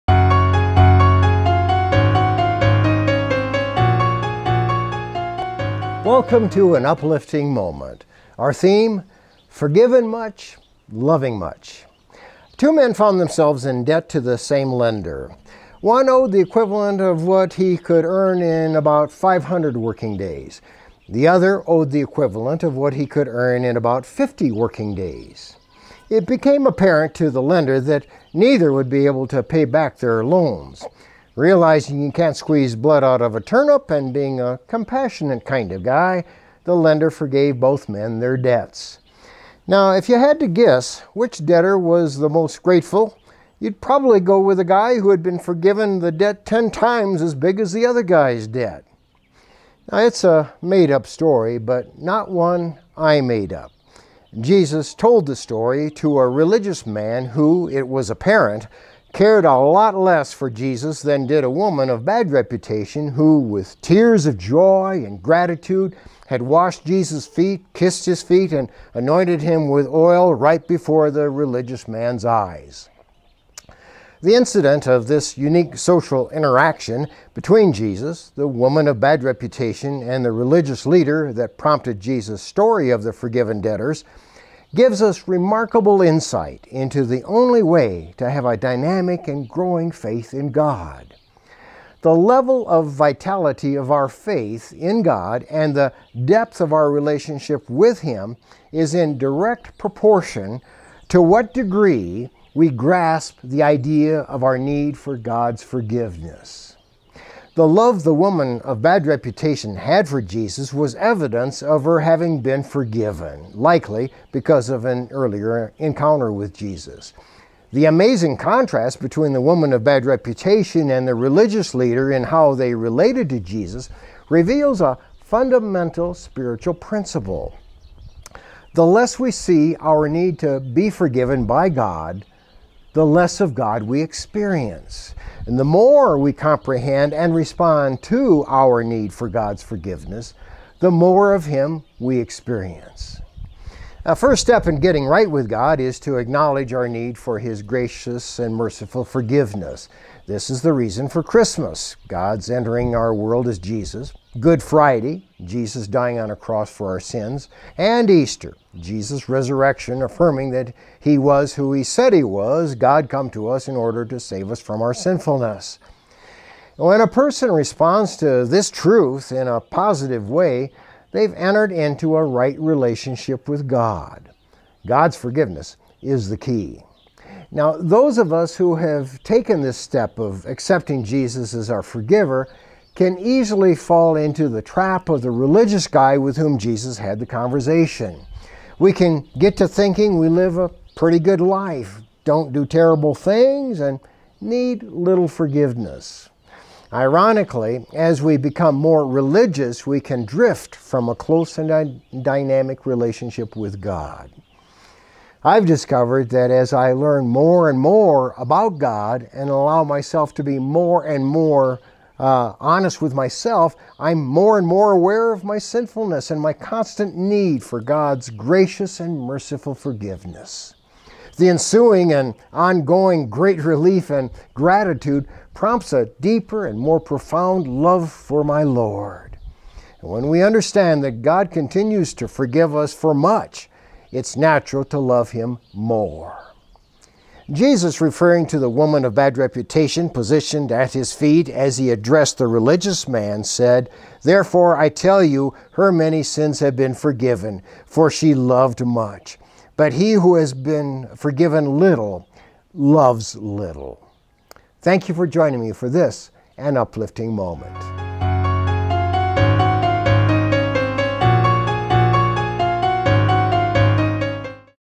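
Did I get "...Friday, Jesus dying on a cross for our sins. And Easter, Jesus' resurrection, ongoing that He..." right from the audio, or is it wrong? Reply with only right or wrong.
wrong.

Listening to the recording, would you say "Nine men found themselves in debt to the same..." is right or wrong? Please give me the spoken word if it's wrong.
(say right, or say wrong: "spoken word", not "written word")
wrong: "Two", not "Nine".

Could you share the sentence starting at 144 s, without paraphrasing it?
A first step in getting right with God is to acknowledge our need for His gracious and merciful forgiveness.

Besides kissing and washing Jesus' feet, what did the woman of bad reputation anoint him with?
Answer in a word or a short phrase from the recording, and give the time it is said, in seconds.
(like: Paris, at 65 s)
Oil, at 69 s.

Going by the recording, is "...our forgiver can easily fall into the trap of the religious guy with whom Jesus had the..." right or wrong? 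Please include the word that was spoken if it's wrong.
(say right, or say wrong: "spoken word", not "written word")
right.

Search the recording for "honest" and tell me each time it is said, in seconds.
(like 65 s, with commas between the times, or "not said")
212 s.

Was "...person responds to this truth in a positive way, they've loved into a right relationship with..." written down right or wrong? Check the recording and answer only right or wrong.
wrong.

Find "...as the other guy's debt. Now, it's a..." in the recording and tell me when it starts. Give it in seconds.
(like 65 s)
47 s.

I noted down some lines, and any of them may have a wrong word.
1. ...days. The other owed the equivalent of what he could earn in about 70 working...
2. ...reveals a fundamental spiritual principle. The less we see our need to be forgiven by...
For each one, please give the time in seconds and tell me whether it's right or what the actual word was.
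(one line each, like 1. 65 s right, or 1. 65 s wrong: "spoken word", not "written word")
1. 20 s wrong: "50", not "70"
2. 124 s right.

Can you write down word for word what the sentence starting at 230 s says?
And when we understand that God continues to forgive us for much, it's natural to love Him more.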